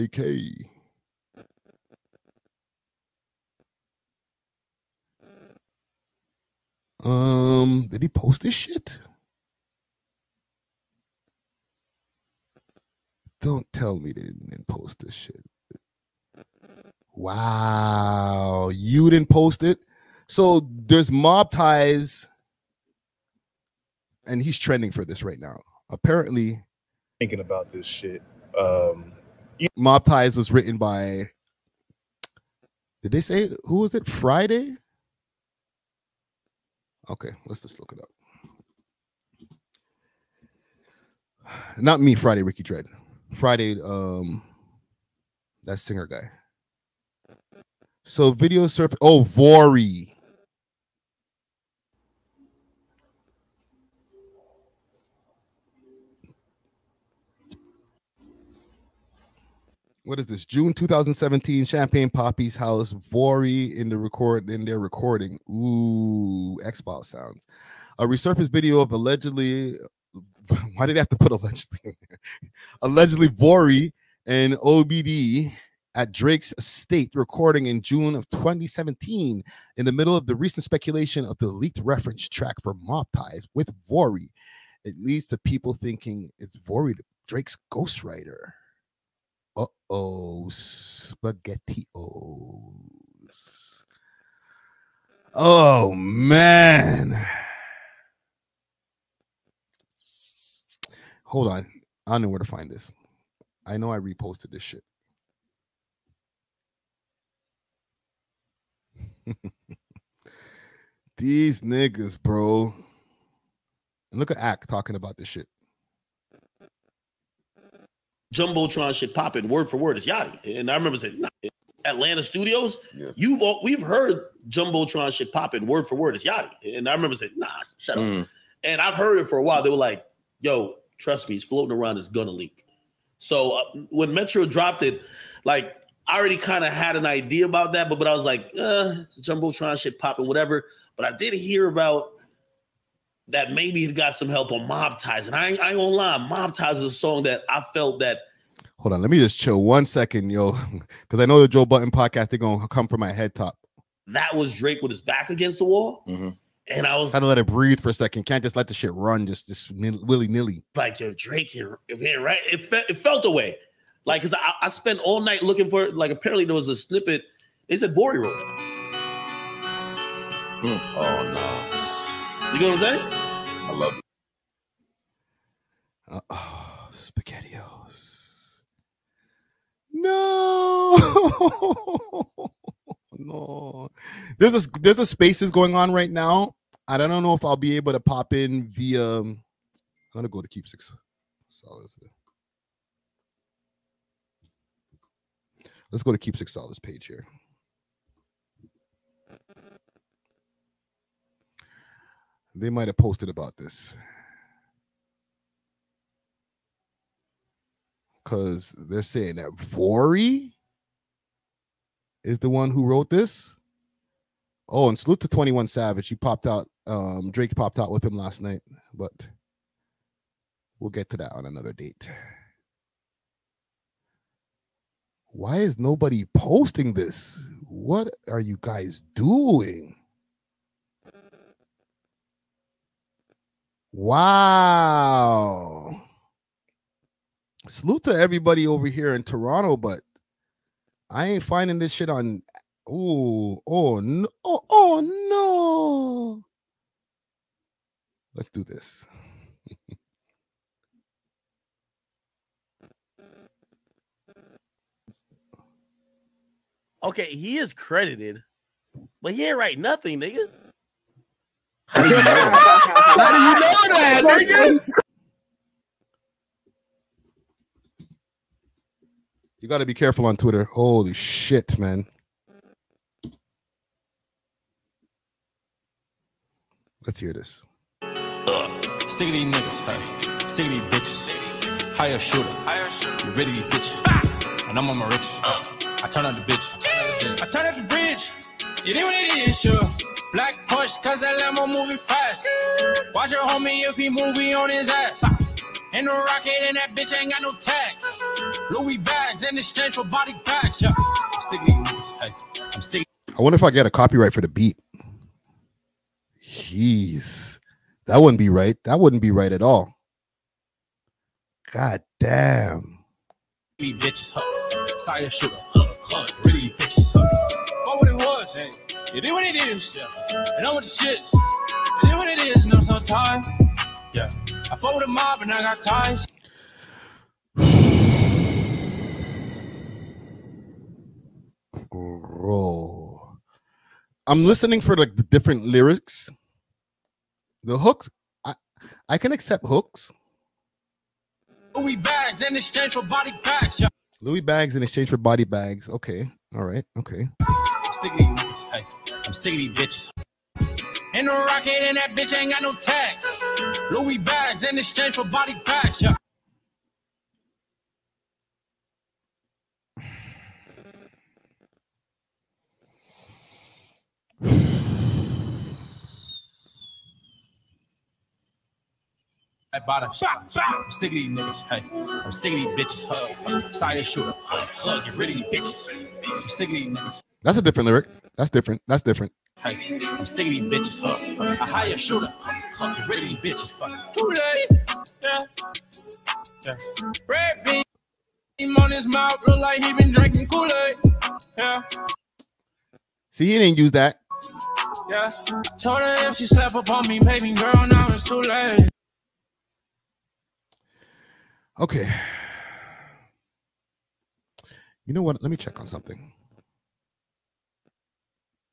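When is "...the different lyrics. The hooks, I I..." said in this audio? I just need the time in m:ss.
5:35.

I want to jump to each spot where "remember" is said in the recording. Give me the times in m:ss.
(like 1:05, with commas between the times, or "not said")
2:00, 2:06.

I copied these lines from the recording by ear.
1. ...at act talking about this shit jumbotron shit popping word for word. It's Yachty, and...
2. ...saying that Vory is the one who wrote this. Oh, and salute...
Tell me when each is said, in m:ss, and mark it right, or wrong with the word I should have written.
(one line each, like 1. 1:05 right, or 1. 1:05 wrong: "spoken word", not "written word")
1. 1:54 right
2. 3:29 right.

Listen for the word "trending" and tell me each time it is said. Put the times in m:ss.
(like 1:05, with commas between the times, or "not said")
0:24.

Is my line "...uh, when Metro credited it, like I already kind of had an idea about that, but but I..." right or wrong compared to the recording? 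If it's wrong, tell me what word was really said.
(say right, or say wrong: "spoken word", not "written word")
wrong: "dropped", not "credited".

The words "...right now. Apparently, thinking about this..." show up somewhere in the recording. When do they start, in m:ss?
0:25.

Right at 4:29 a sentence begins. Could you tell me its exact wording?
You got to be careful on Twitter.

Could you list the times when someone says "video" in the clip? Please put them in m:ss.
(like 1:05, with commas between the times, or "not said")
0:48, 1:08.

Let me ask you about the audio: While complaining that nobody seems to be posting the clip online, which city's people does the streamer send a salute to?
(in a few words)
Toronto.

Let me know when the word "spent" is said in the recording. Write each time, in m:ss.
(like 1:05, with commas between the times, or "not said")
2:44.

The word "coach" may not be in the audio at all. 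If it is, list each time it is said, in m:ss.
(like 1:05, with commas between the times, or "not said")
not said.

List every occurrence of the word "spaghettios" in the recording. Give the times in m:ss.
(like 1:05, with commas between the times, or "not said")
1:30, 2:56.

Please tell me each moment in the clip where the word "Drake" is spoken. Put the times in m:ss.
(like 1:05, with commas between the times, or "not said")
1:16, 1:27, 2:34, 2:41, 3:37.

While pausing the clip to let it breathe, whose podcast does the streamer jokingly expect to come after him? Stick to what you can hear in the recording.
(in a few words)
Joe Budden.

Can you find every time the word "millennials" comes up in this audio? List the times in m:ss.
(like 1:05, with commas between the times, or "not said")
not said.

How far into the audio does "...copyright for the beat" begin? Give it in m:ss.
5:03.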